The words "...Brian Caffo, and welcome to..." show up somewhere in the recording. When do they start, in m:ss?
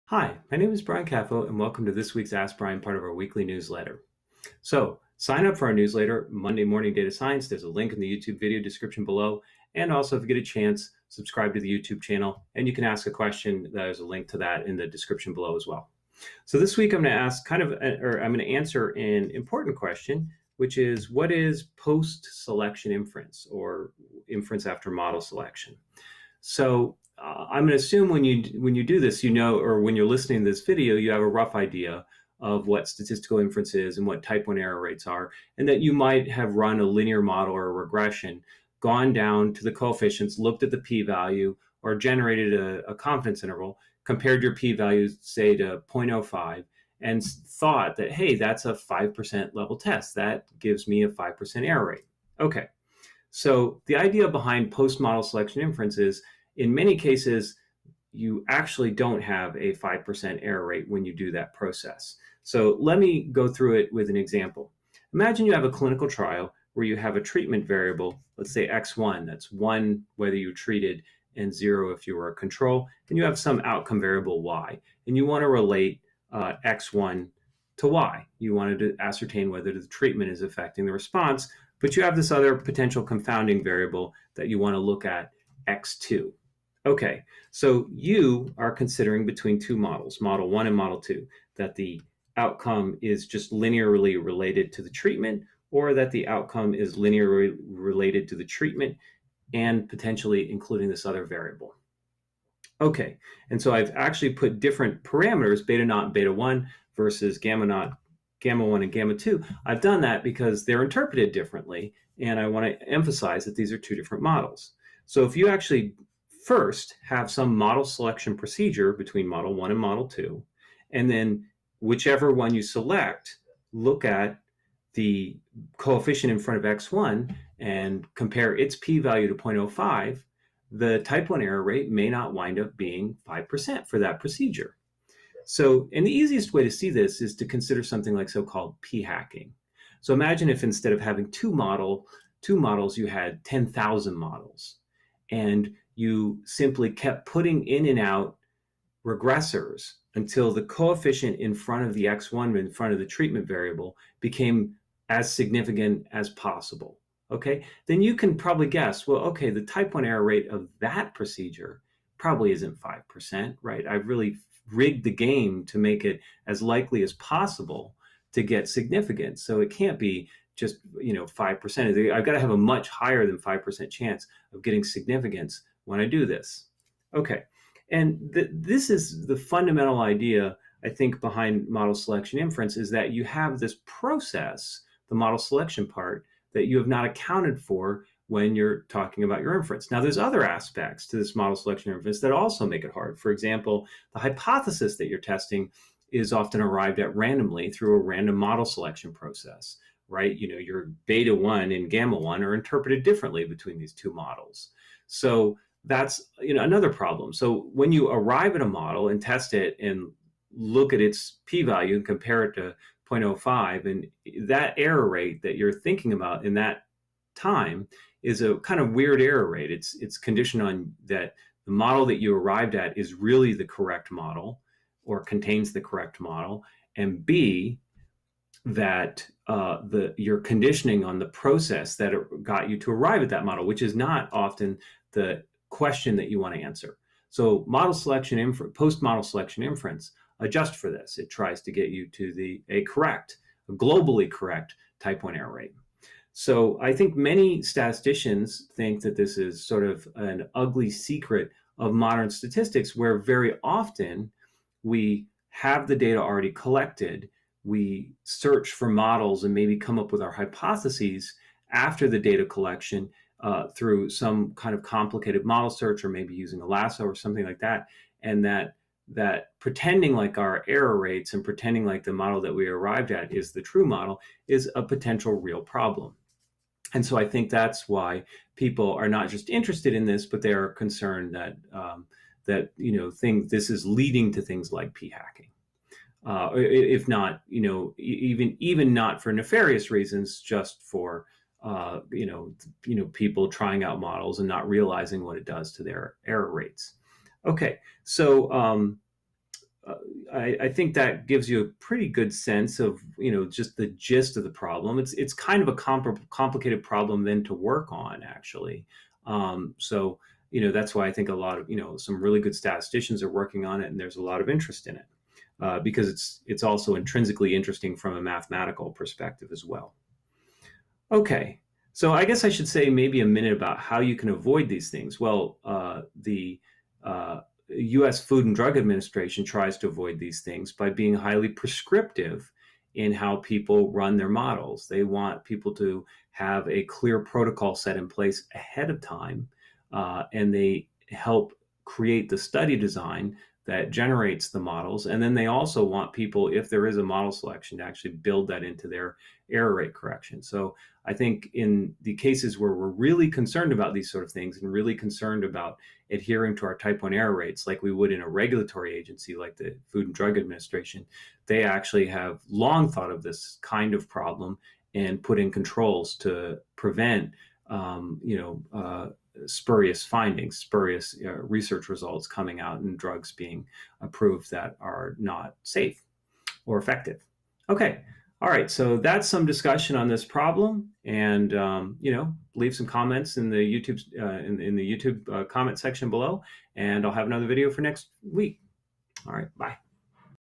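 0:00.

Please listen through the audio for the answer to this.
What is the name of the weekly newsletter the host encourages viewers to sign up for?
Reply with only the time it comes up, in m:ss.
0:06.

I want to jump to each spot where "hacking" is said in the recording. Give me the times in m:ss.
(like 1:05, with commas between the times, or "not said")
2:18, 4:45.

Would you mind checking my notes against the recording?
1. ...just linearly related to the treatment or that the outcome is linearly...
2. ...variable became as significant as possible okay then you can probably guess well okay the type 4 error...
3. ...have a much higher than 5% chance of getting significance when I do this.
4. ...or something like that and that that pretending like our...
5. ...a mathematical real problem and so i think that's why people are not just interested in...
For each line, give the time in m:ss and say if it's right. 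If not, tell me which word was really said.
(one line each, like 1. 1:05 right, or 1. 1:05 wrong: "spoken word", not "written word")
1. 1:33 right
2. 2:33 wrong: "1", not "4"
3. 2:52 right
4. 4:27 right
5. 4:34 wrong: "potential", not "mathematical".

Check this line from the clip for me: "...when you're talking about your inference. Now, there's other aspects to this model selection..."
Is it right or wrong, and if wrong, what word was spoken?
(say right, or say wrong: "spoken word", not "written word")
right.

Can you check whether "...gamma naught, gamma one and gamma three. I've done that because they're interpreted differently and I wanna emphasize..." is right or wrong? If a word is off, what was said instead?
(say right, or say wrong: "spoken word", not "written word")
wrong: "two", not "three".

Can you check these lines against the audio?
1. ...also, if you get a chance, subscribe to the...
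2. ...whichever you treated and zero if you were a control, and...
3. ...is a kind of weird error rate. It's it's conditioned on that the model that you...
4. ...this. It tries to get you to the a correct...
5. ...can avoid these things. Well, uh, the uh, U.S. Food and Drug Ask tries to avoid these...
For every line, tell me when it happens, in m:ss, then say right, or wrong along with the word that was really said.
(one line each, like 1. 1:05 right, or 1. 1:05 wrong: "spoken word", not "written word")
1. 0:09 right
2. 1:10 wrong: "whether", not "whichever"
3. 3:38 right
4. 4:00 right
5. 5:24 wrong: "Administration", not "Ask".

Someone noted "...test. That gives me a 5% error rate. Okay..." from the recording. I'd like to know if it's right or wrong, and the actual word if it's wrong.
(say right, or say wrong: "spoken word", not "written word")
right.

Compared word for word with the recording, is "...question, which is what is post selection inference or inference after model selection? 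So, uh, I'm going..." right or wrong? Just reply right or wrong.
right.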